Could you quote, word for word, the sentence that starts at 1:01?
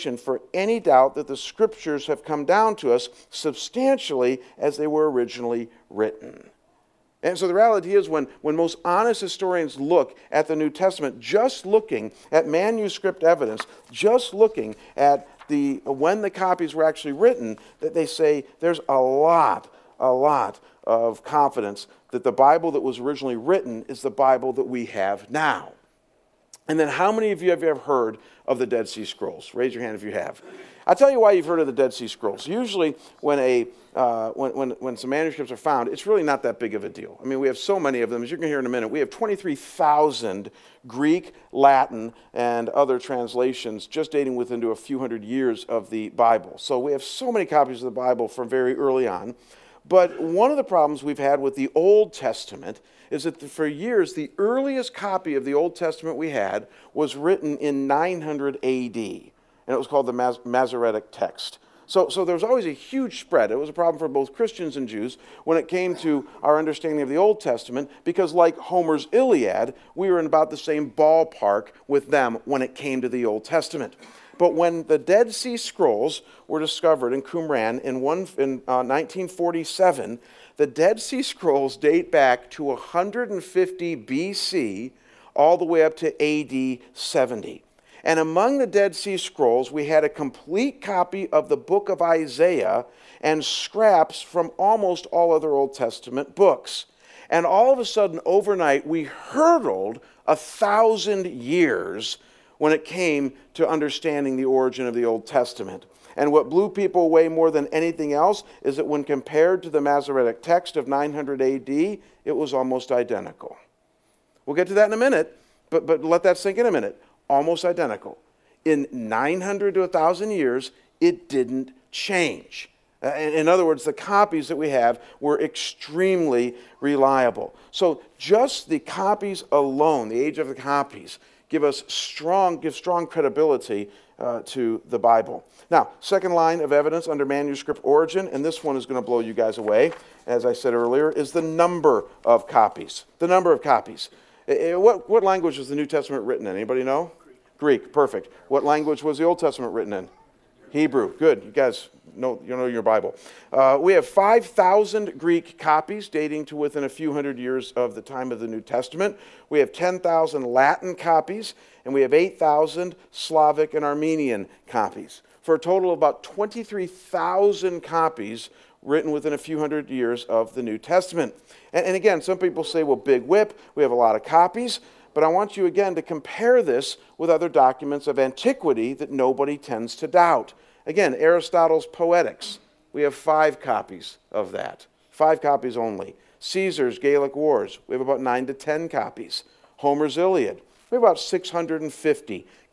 So, so there was always a huge spread.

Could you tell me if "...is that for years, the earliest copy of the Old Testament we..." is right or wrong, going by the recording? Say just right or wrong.
right.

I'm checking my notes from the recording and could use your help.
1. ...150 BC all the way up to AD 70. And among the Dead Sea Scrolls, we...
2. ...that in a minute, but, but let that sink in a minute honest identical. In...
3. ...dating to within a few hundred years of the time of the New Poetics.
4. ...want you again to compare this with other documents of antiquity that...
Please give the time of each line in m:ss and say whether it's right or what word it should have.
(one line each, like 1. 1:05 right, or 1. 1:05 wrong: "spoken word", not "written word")
1. 1:22 right
2. 1:54 wrong: "almost", not "honest"
3. 2:36 wrong: "Testament", not "Poetics"
4. 2:55 right.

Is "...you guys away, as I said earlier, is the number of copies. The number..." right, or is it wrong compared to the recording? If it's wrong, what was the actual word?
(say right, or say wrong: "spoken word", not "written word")
right.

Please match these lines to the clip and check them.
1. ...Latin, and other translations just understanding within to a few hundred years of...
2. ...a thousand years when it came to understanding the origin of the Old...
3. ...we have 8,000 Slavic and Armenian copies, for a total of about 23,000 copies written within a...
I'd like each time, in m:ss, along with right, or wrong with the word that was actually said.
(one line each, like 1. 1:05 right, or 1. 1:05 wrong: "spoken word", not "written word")
1. 0:41 wrong: "dating", not "understanding"
2. 1:40 right
3. 2:41 right.